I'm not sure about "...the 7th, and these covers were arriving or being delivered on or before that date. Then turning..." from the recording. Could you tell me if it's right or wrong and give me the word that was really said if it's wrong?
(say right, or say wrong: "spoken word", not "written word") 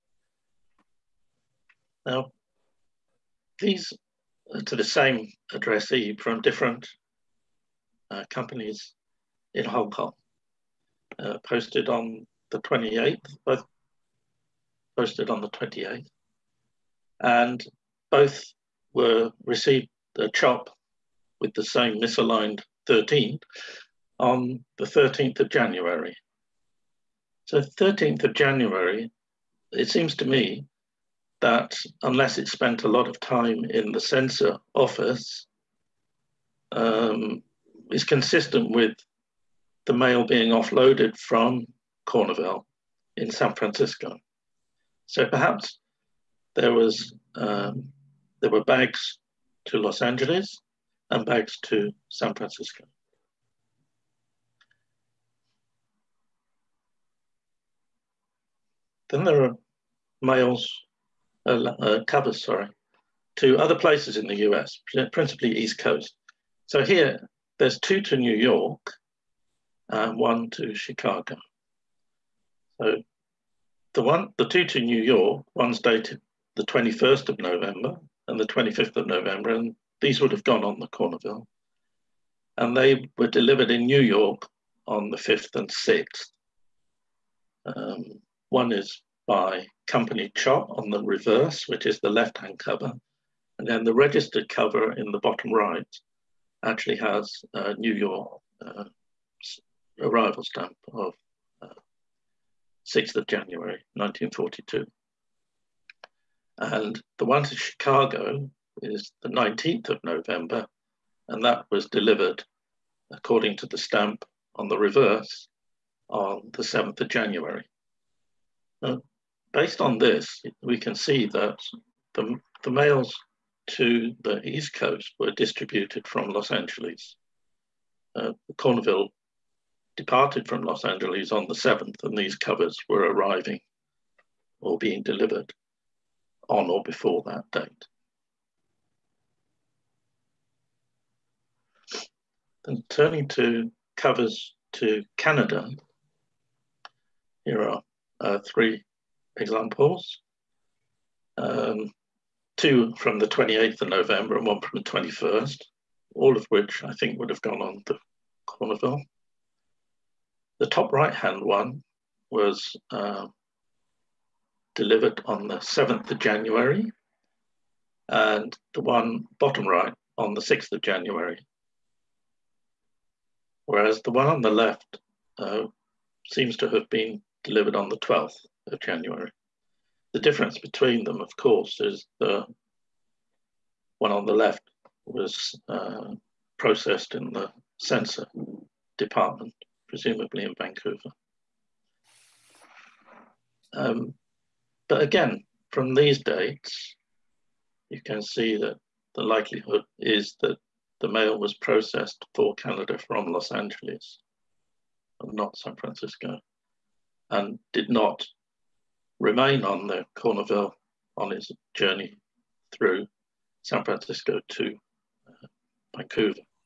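right.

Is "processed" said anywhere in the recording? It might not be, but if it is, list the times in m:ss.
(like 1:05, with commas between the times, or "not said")
3:06, 3:21.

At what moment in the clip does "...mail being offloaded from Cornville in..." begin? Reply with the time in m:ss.
0:39.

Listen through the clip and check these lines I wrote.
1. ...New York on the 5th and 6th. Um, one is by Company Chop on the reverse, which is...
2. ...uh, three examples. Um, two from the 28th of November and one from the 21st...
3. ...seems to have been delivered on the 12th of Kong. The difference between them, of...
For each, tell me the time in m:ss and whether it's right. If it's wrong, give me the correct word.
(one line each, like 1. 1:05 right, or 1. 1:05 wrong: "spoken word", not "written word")
1. 1:23 right
2. 2:28 right
3. 2:56 wrong: "January", not "Kong".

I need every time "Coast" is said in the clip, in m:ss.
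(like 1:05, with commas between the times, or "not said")
1:05, 2:04.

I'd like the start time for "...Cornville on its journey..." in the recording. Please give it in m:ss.
3:30.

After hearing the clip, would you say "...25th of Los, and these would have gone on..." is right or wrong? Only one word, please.
wrong.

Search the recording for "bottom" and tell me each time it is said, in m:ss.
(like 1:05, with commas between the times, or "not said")
1:35, 2:49.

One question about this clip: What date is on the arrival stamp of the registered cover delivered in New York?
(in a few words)
6th of January 1942.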